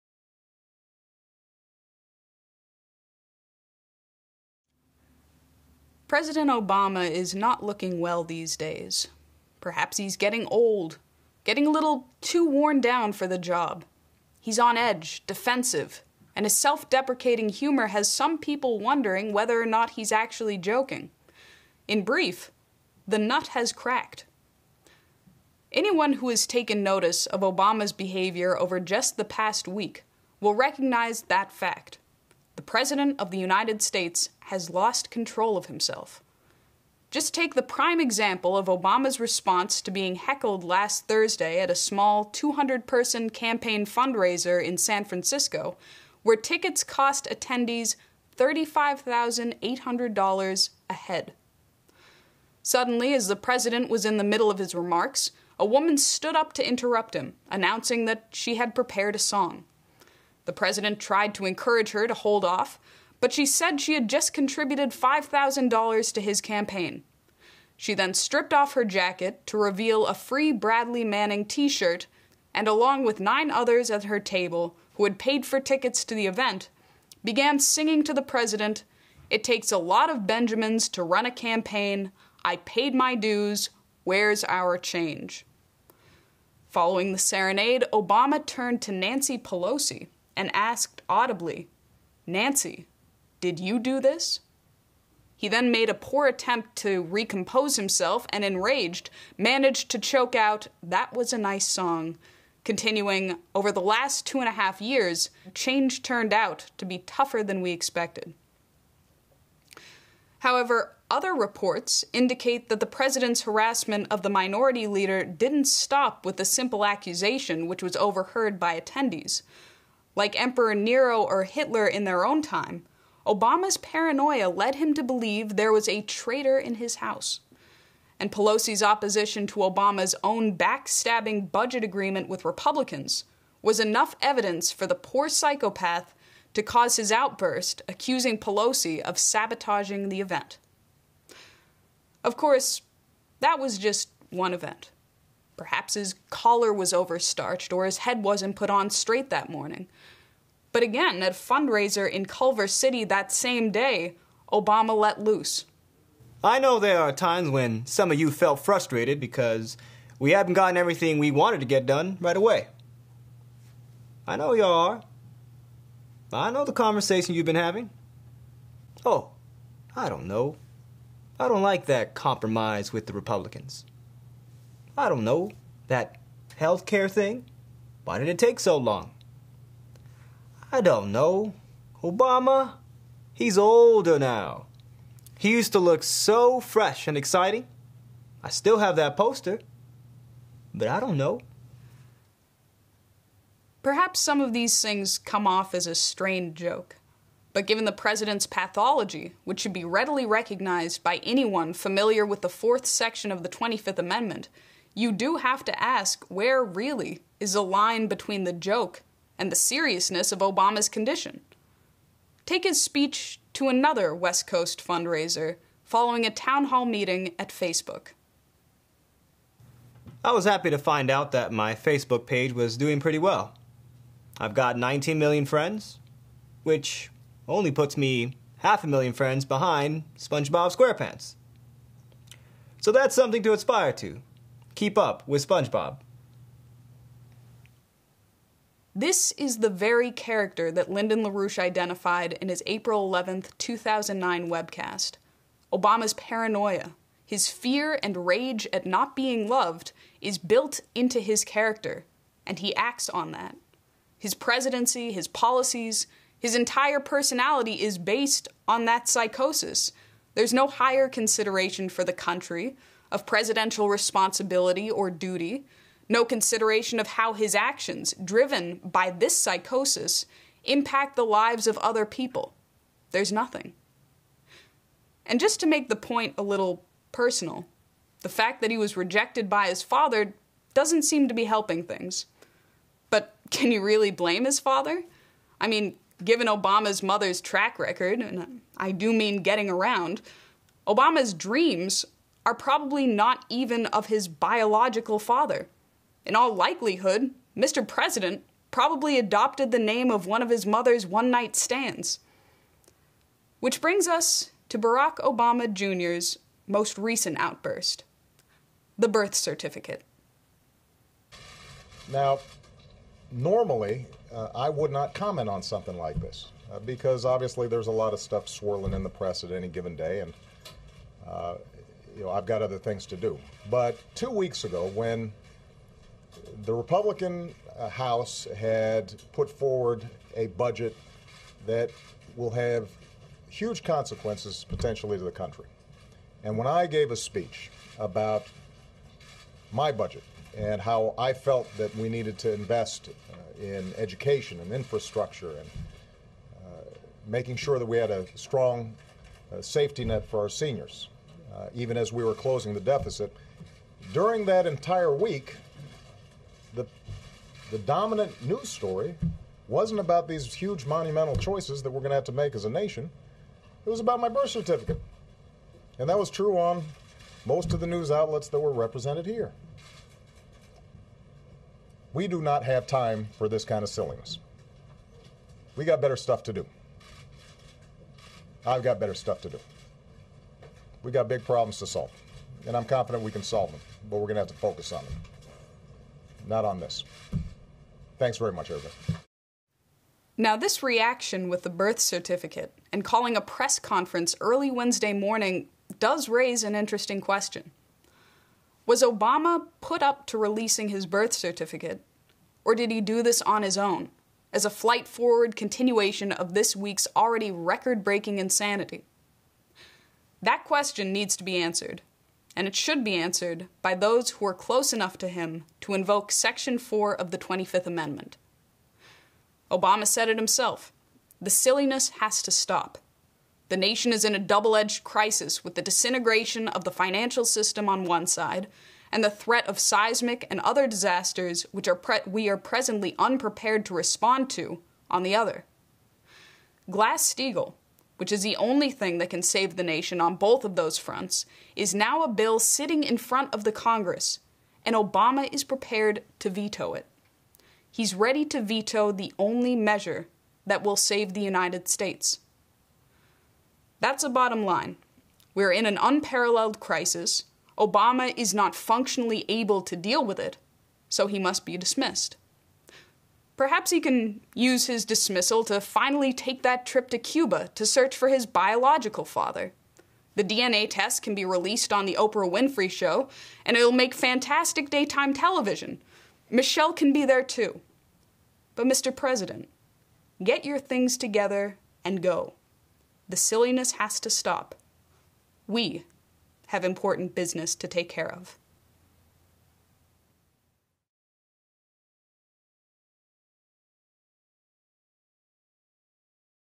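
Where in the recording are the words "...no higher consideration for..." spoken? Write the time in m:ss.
4:20.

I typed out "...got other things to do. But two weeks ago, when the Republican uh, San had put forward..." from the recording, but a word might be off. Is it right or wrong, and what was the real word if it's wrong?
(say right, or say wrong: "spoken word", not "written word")
wrong: "House", not "San".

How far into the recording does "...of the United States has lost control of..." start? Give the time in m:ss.
0:33.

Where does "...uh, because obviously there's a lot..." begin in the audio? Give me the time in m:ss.
5:16.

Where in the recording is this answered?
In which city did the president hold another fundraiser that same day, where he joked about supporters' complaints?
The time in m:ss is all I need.
2:32.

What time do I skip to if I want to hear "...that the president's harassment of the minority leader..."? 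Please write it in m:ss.
1:52.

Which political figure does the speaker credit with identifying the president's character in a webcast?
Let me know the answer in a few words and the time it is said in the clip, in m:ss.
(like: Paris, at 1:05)
Lyndon LaRouche, at 4:00.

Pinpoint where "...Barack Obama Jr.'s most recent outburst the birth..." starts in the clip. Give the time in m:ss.
5:04.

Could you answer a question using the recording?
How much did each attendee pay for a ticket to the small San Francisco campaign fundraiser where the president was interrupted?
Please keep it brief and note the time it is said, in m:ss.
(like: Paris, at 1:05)
$35,800, at 0:48.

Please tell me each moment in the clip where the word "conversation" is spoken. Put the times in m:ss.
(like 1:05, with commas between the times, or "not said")
2:46.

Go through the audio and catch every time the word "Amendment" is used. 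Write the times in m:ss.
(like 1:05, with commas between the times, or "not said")
3:23, 6:57.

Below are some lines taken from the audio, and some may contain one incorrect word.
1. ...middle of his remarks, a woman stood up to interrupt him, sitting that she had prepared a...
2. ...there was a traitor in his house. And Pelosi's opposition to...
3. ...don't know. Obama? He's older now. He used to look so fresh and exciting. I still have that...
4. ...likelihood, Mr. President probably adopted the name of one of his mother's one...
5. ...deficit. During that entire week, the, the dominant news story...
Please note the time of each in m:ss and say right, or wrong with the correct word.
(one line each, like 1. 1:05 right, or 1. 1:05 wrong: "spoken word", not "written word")
1. 0:54 wrong: "announcing", not "sitting"
2. 2:05 right
3. 3:00 right
4. 4:56 right
5. 5:52 right.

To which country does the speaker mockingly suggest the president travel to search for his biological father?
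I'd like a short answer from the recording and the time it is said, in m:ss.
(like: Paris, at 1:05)
Cuba, at 7:47.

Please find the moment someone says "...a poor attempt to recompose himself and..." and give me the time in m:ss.
1:35.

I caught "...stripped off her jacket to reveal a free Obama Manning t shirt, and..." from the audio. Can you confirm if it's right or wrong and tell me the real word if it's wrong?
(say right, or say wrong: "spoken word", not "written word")
wrong: "Bradley", not "Obama".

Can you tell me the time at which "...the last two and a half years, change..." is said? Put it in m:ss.
1:43.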